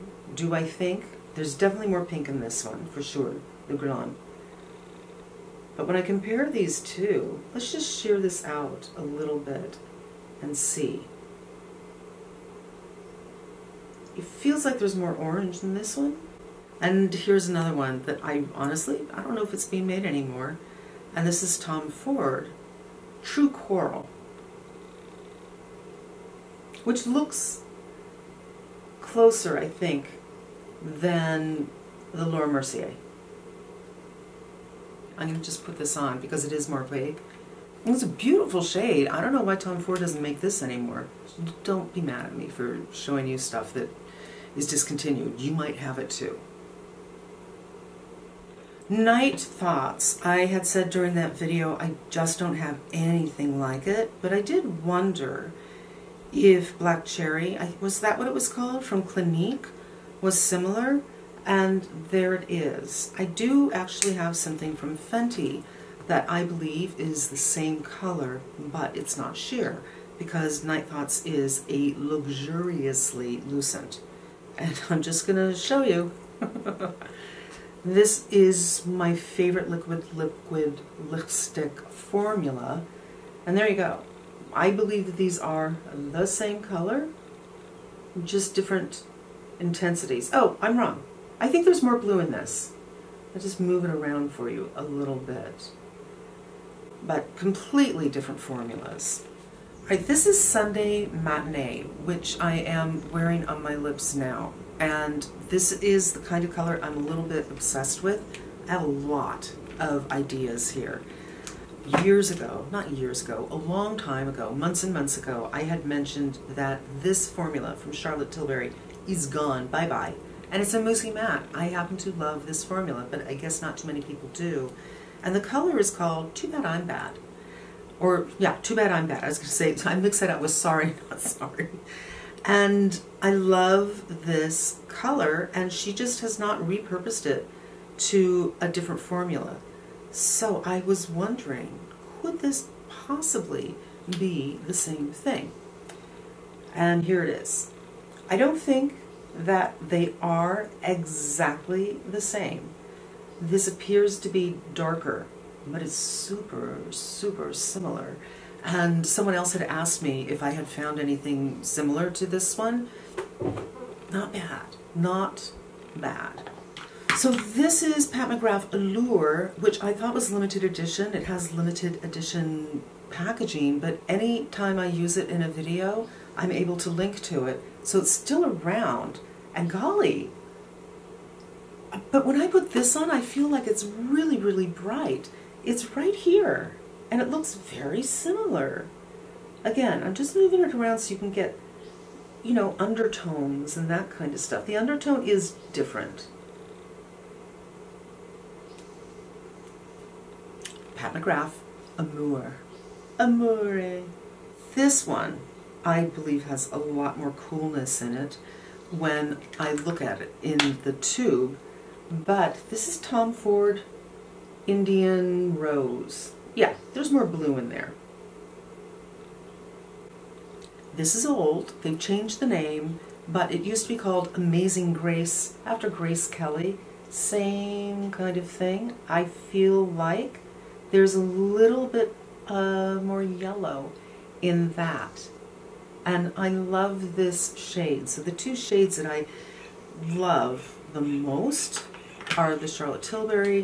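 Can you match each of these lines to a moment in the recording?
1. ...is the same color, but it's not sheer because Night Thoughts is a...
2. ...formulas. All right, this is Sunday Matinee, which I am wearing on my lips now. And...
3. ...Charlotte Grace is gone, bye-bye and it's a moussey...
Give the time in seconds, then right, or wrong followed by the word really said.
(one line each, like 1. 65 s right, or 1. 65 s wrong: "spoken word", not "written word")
1. 67 s right
2. 98 s right
3. 117 s wrong: "Tilbury", not "Grace".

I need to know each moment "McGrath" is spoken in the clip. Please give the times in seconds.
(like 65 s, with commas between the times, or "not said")
168 s, 201 s.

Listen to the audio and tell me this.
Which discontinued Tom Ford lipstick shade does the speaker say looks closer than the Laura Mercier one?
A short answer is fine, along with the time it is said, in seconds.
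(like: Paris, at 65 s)
True Coral, at 23 s.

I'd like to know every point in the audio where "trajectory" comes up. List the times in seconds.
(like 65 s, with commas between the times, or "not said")
not said.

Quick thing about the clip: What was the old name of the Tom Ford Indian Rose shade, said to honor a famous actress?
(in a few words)
Amazing Grace.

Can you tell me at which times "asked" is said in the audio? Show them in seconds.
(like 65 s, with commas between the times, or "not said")
159 s.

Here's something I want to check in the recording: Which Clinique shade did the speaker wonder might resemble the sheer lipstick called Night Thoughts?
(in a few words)
Black Cherry.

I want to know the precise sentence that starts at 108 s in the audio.
I have a lot of ideas here.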